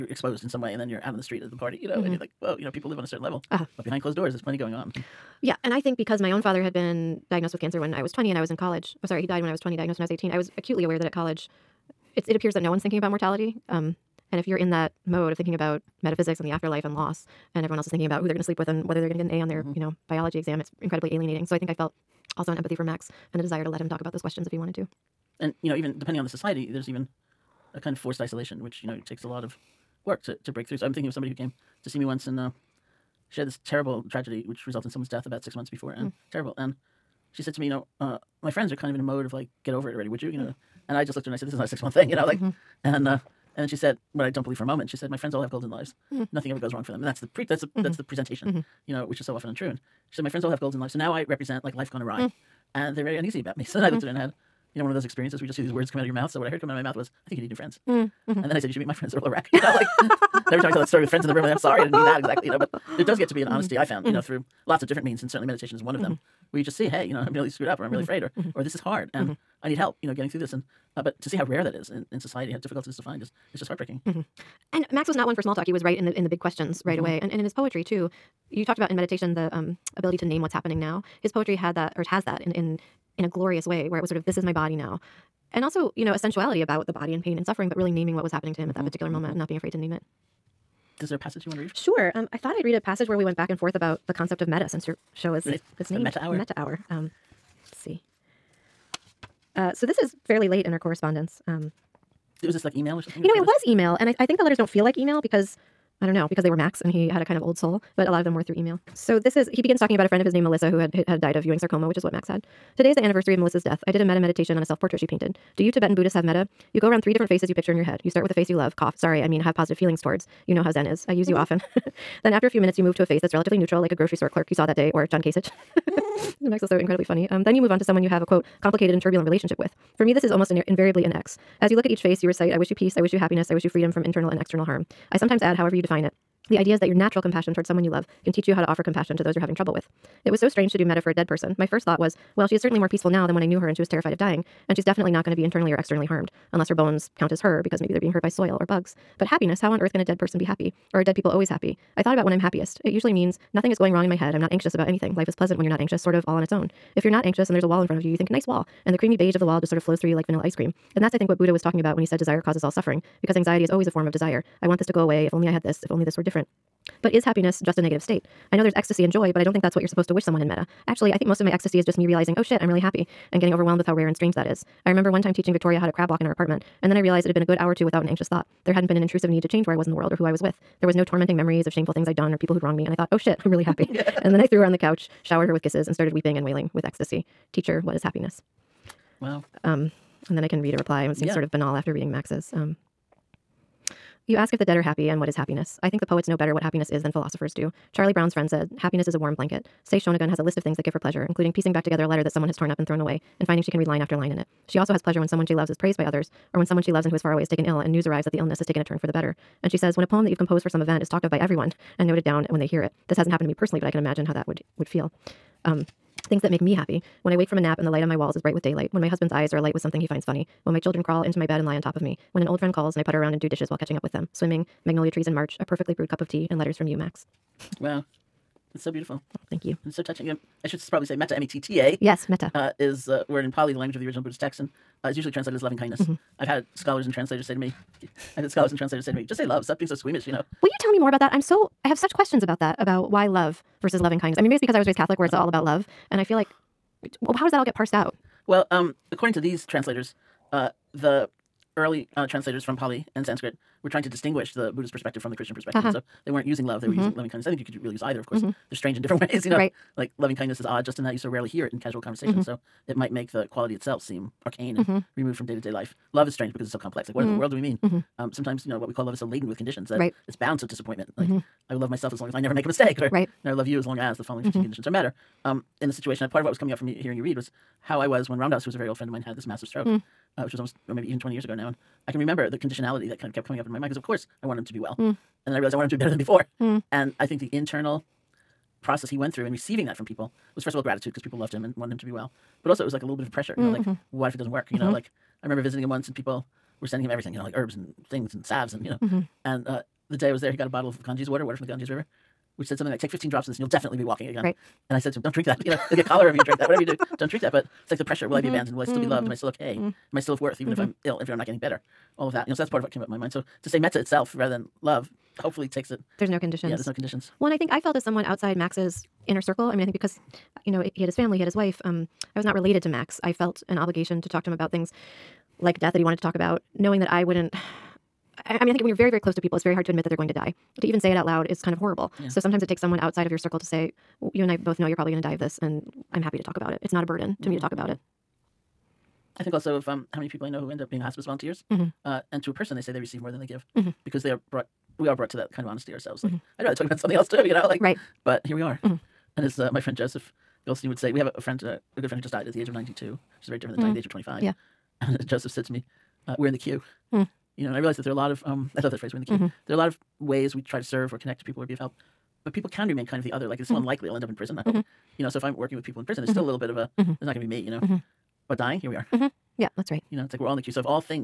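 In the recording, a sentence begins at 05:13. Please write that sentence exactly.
So to say metta itself rather than love hopefully takes it.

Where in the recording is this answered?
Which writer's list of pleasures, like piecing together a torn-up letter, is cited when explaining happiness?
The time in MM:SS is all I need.
03:19.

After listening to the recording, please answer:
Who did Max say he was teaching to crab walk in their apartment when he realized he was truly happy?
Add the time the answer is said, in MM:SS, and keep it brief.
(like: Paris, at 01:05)
Victoria, at 02:55.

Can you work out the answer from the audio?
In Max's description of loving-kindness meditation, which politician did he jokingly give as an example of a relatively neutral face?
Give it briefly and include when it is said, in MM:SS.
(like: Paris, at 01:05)
John Kasich, at 02:05.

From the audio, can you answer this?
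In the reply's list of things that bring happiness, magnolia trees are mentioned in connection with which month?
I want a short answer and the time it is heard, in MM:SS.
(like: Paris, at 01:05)
March, at 03:45.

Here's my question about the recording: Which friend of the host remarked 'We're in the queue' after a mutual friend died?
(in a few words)
Joseph Goldstein.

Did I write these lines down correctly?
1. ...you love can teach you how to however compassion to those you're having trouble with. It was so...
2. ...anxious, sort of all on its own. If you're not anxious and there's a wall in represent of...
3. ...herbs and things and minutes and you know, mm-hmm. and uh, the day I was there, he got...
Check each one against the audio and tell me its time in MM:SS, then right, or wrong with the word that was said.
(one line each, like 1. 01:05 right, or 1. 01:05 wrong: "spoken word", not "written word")
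1. 02:17 wrong: "offer", not "however"
2. 02:35 wrong: "front", not "represent"
3. 04:57 wrong: "salves", not "minutes".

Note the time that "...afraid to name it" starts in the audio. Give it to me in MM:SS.
01:29.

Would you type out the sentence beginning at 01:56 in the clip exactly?
You go around three different faces you picture in your head.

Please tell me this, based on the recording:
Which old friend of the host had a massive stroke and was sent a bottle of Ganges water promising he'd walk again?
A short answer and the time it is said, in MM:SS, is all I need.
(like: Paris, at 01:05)
Ram Dass, at 04:38.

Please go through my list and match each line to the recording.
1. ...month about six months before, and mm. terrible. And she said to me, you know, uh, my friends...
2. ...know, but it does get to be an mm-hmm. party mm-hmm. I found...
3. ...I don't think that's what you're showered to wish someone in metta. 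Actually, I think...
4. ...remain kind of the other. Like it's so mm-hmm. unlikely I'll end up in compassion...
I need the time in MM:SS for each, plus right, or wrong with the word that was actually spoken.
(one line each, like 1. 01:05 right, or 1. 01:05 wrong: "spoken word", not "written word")
1. 00:35 wrong: "death", not "month"
2. 01:02 wrong: "honesty", not "party"
3. 02:49 wrong: "supposed", not "showered"
4. 06:02 wrong: "prison", not "compassion".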